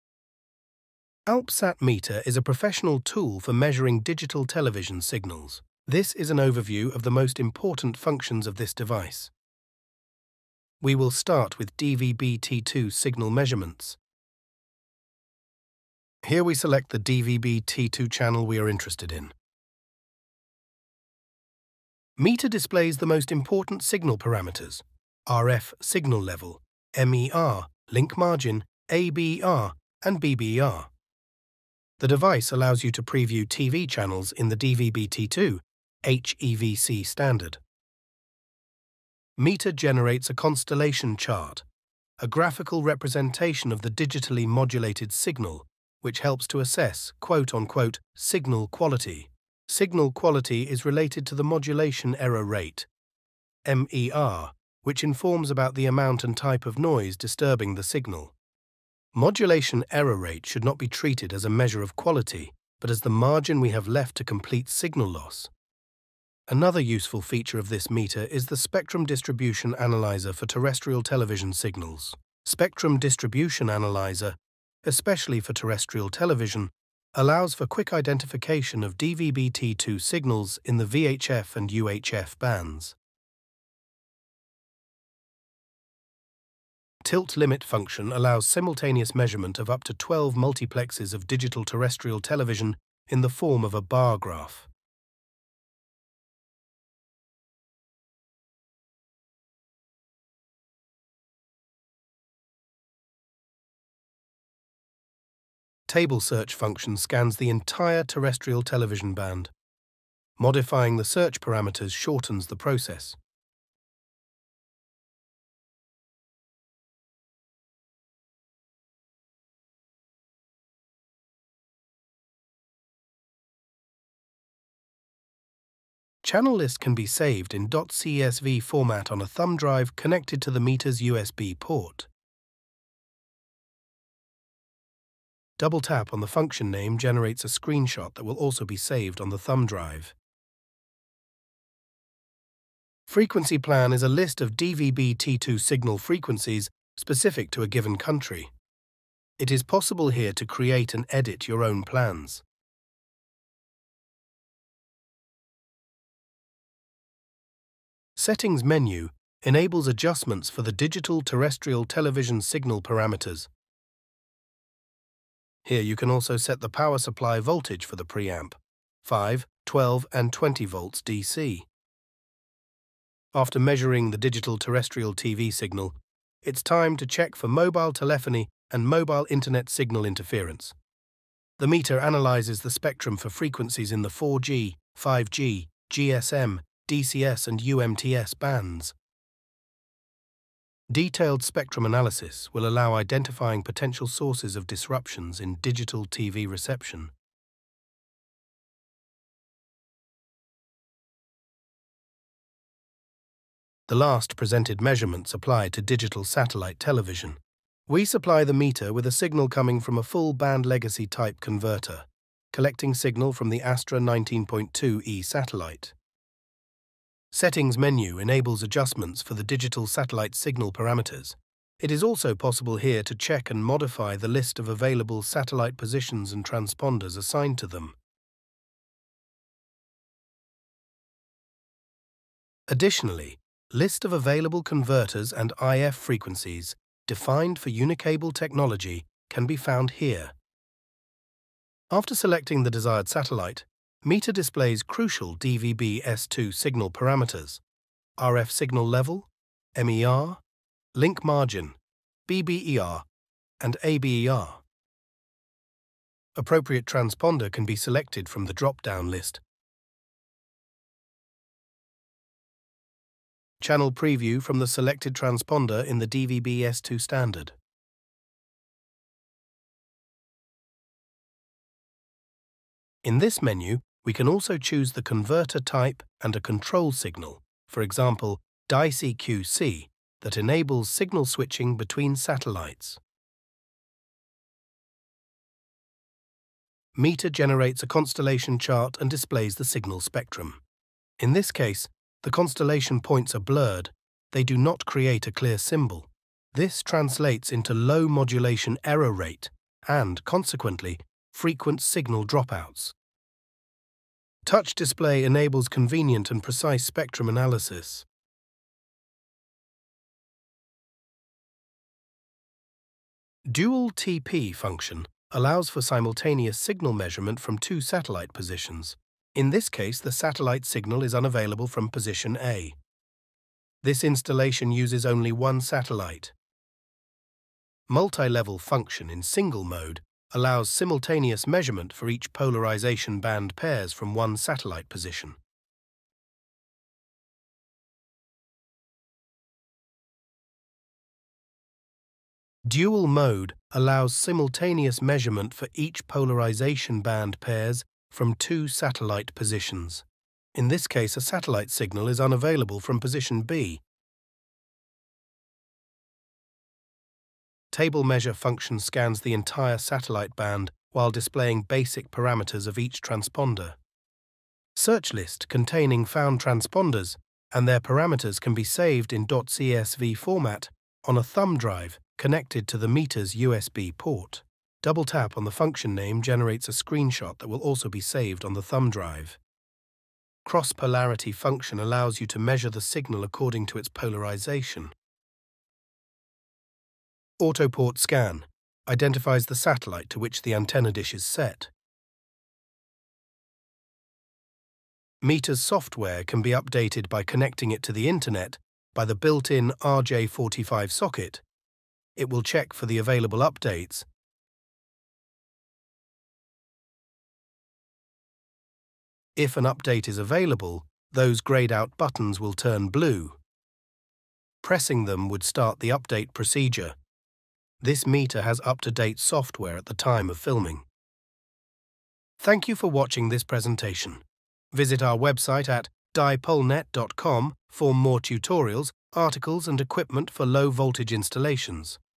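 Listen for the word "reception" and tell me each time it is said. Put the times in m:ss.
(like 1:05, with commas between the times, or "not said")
3:16.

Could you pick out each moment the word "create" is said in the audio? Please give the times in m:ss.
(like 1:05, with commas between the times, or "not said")
2:30, 4:54.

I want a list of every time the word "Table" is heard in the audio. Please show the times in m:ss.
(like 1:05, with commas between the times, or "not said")
1:45, 5:57.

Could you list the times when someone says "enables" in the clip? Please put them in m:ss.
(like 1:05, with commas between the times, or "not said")
2:39, 3:38, 4:40, 5:05.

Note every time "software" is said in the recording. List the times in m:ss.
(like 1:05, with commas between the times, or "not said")
6:35, 6:59.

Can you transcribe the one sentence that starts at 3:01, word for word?
The meter analyzes the spectrum for frequencies in the 4G, 5G, GSM, DCS and UMTS bands.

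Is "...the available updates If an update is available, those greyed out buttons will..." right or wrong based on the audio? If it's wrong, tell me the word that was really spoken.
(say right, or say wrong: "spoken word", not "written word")
right.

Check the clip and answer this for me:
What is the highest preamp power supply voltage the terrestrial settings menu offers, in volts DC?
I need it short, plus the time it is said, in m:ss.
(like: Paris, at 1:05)
20, at 2:50.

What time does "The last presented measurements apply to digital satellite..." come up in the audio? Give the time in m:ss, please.
3:23.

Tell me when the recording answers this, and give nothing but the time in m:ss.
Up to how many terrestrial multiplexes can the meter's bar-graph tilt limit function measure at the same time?
1:29.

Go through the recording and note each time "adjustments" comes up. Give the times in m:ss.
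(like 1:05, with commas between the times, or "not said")
2:39, 3:38.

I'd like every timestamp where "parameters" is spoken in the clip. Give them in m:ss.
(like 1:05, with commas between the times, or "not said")
0:24, 1:51, 2:42, 3:40, 4:06, 6:02, 6:07.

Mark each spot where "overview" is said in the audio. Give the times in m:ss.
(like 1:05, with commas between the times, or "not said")
0:06.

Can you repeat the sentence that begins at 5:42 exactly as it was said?
Dual mode allows simultaneous measurement for each polarization band pairs from two satellite positions.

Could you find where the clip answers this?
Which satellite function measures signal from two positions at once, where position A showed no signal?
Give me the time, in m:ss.
5:13.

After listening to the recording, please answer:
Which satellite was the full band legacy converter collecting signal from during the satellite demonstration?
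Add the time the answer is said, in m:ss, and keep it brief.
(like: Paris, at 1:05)
Astra 19.2e, at 3:33.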